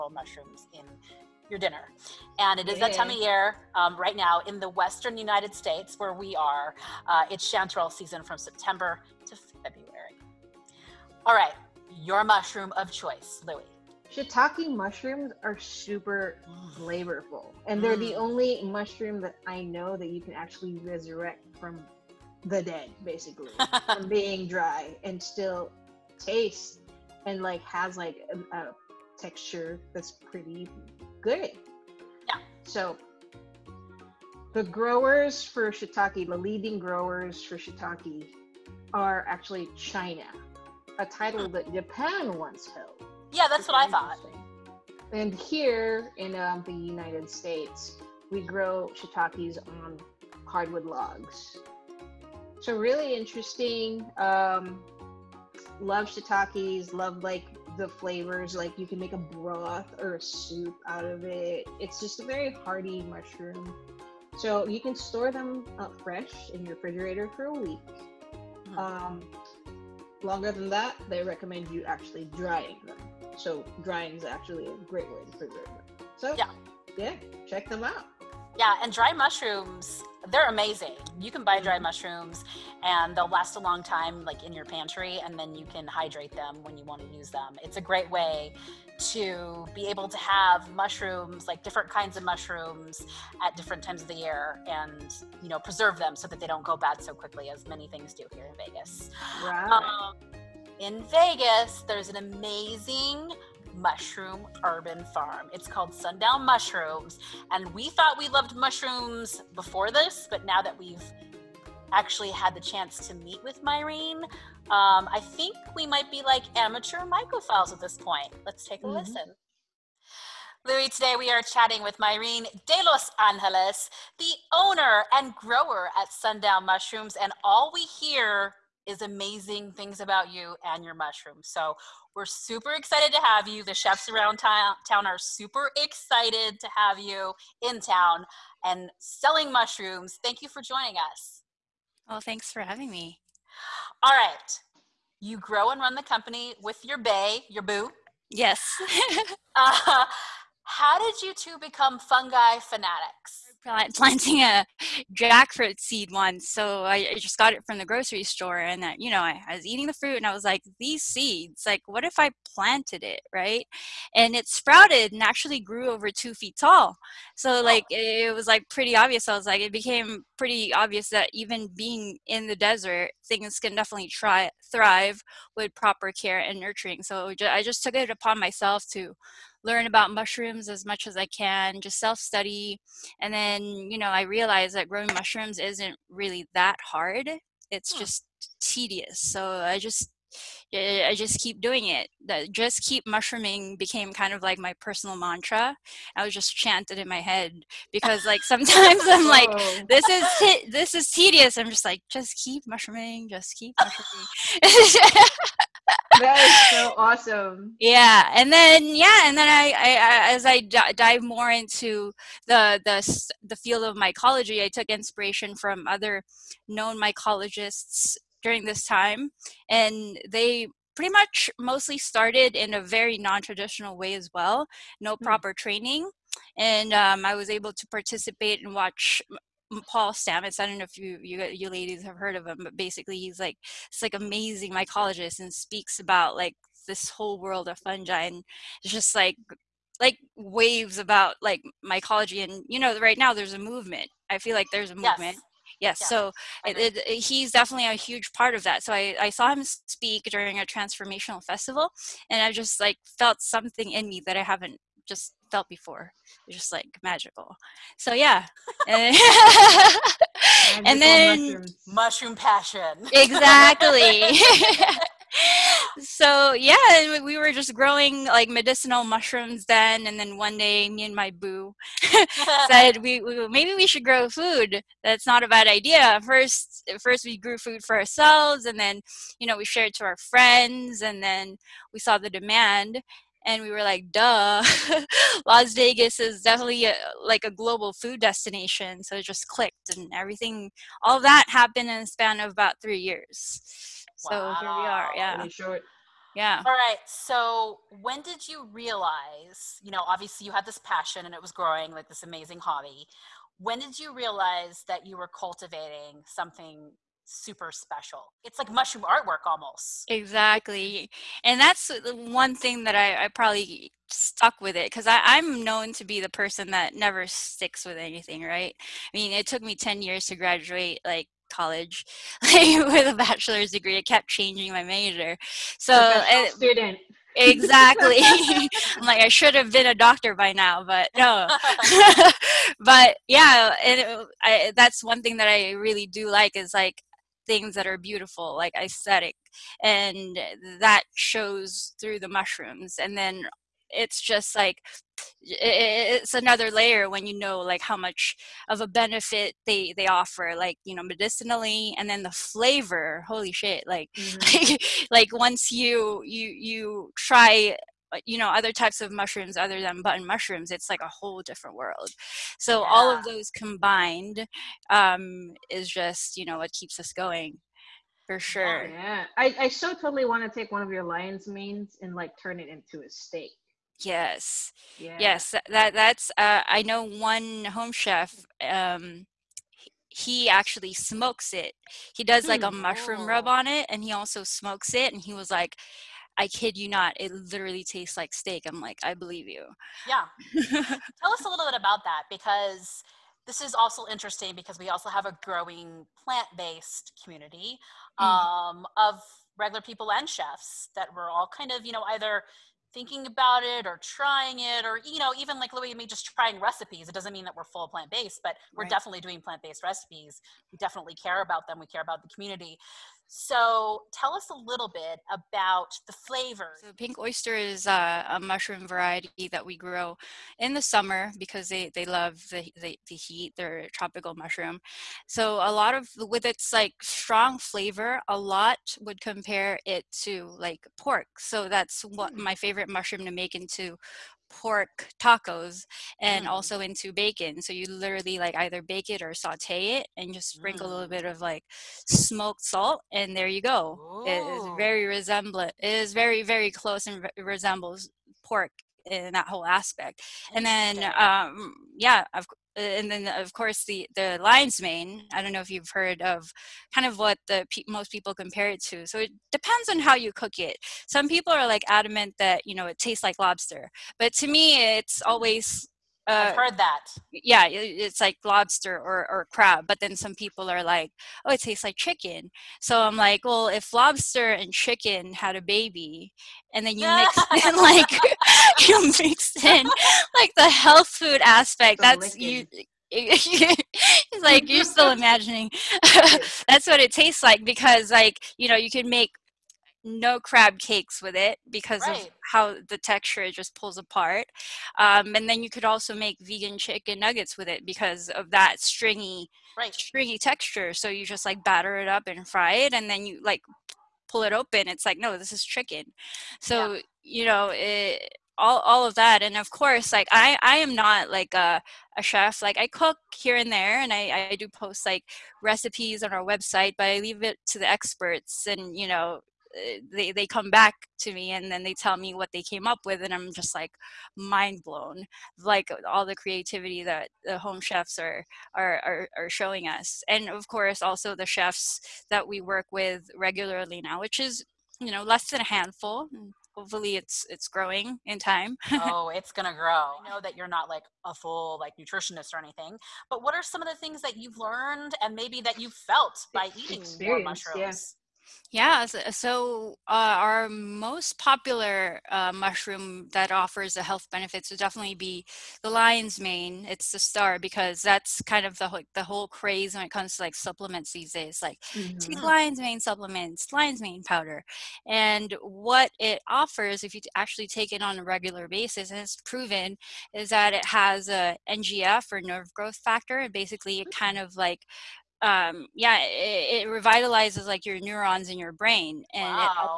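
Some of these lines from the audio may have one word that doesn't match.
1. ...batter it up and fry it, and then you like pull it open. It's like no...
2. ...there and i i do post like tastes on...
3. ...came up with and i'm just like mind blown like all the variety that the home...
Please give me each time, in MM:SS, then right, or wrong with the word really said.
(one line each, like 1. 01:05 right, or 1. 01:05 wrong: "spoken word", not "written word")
1. 08:21 right
2. 08:33 wrong: "recipes", not "tastes"
3. 08:42 wrong: "creativity", not "variety".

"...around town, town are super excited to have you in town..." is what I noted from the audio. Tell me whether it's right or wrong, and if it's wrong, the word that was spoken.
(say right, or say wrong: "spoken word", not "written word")
right.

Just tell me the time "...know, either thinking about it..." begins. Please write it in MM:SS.
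06:41.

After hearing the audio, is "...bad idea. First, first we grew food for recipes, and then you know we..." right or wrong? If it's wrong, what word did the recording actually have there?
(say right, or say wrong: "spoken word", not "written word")
wrong: "ourselves", not "recipes".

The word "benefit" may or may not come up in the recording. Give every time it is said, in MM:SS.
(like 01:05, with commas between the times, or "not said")
05:48, 09:14.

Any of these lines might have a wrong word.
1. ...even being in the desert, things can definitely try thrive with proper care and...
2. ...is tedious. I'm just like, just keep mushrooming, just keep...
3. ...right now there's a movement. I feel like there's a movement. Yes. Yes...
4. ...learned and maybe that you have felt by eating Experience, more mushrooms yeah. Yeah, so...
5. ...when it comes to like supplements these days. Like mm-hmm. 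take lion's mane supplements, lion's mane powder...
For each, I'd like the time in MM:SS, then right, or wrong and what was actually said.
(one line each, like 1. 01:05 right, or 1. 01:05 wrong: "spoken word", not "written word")
1. 02:51 right
2. 03:20 right
3. 04:02 right
4. 09:04 right
5. 09:19 right.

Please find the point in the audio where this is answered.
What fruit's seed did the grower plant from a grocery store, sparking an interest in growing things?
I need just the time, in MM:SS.
02:35.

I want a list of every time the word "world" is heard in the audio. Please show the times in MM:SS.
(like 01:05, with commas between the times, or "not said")
03:57, 06:01.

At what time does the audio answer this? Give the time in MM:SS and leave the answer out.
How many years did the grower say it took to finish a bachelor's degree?
05:19.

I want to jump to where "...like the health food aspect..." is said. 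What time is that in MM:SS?
08:00.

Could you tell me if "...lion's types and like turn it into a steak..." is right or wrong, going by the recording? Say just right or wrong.
wrong.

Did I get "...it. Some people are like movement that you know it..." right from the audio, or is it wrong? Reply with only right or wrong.
wrong.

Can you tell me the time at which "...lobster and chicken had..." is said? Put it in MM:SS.
07:53.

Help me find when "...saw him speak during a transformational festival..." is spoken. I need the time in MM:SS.
04:09.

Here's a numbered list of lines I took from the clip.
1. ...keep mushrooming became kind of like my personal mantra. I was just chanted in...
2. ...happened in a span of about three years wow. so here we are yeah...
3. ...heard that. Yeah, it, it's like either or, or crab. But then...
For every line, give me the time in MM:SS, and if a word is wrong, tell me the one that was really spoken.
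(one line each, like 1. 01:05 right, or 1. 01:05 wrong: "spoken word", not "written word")
1. 03:12 right
2. 04:51 right
3. 07:46 wrong: "lobster", not "either".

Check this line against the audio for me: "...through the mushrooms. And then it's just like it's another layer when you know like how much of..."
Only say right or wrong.
right.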